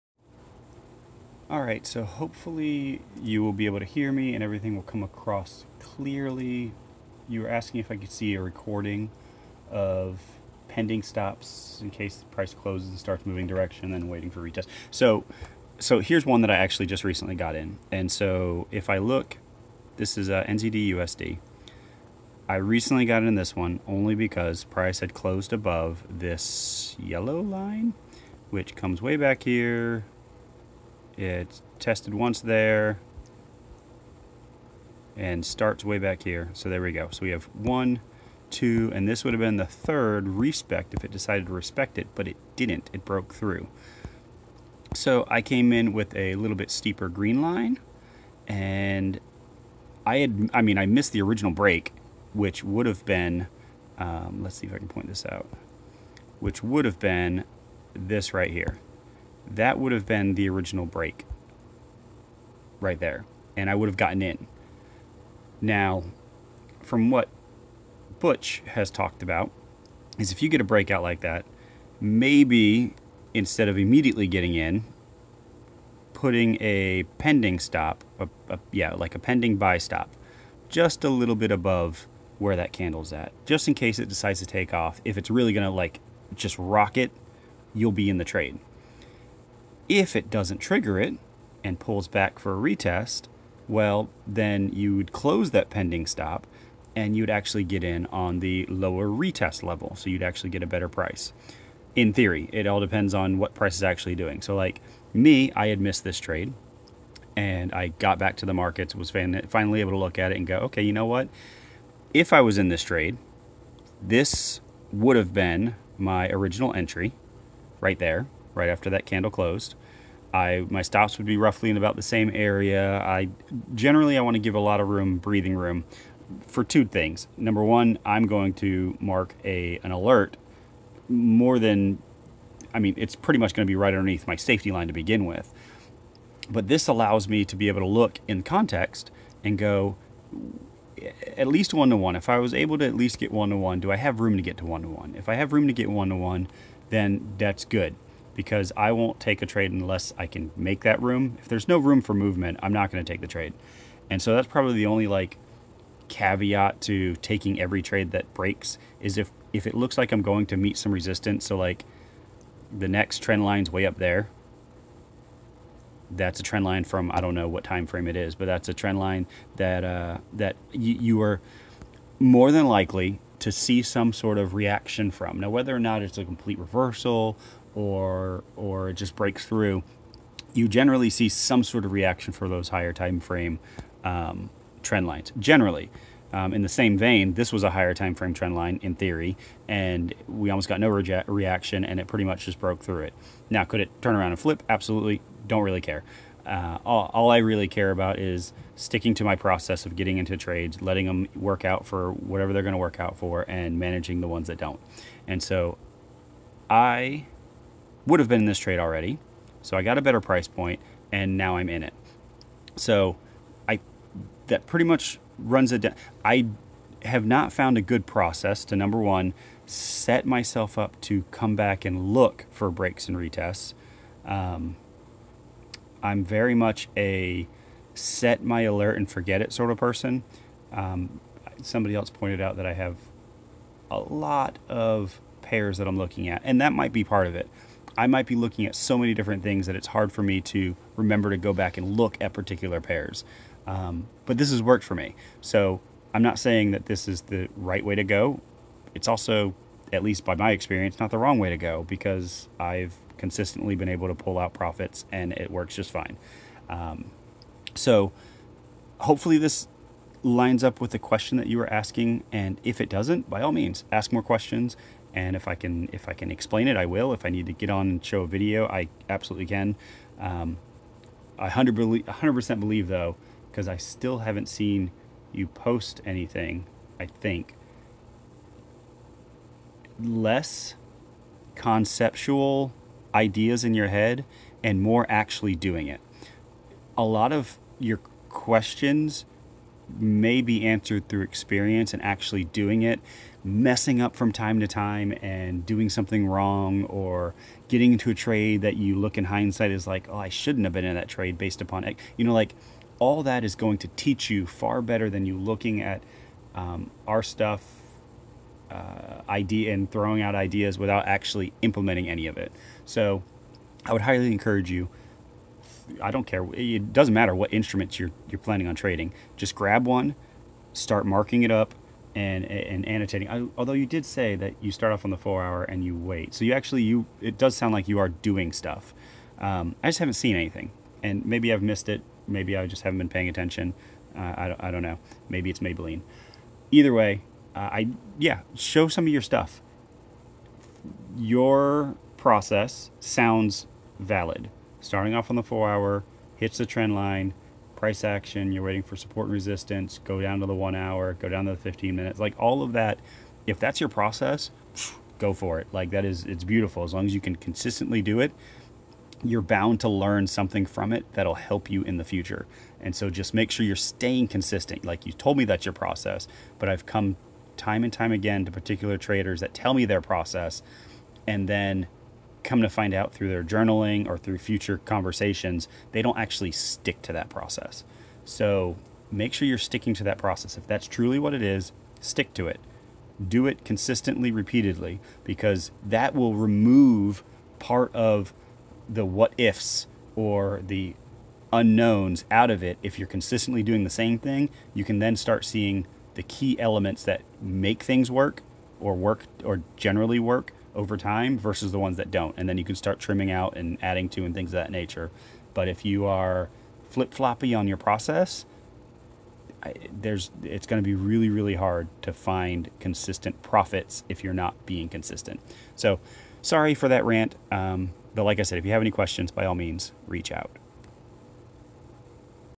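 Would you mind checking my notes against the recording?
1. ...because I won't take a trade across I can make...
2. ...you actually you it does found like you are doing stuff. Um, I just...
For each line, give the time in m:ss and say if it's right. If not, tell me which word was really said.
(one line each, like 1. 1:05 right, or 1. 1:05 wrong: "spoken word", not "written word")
1. 2:28 wrong: "unless", not "across"
2. 5:26 wrong: "sound", not "found".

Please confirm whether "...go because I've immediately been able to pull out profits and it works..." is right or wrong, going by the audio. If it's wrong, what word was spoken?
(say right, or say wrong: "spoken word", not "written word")
wrong: "consistently", not "immediately".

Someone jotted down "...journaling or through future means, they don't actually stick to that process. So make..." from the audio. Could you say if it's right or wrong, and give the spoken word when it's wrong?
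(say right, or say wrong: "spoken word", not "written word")
wrong: "conversations", not "means".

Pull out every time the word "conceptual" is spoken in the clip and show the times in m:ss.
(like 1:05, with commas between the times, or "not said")
4:41.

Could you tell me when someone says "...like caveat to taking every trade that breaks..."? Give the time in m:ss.
2:35.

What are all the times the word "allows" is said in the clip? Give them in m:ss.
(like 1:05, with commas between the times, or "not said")
2:16.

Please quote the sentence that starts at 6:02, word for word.
And so just make sure you're staying consistent.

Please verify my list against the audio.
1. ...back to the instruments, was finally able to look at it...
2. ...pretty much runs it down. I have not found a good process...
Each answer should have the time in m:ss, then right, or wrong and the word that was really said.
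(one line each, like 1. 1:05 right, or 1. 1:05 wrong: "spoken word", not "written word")
1. 1:48 wrong: "markets", not "instruments"
2. 3:34 right.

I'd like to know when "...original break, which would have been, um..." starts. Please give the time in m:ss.
0:51.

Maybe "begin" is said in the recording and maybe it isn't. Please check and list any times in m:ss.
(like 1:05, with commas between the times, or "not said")
2:14.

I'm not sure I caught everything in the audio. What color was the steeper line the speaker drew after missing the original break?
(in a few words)
Green.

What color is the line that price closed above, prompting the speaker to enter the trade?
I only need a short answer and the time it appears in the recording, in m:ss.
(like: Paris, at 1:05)
Yellow, at 0:26.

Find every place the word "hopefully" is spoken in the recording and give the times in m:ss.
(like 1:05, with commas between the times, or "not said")
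0:02, 4:18.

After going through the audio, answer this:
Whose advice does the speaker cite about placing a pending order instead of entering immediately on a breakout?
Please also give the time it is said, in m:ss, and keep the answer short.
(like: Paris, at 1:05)
Butch, at 1:08.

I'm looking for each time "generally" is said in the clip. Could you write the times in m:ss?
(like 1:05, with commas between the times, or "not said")
2:03, 3:00, 3:05, 6:39.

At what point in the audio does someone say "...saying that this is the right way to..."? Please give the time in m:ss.
4:06.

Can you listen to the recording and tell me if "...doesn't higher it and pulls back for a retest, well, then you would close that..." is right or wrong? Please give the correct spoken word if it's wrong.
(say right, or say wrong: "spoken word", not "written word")
wrong: "trigger", not "higher".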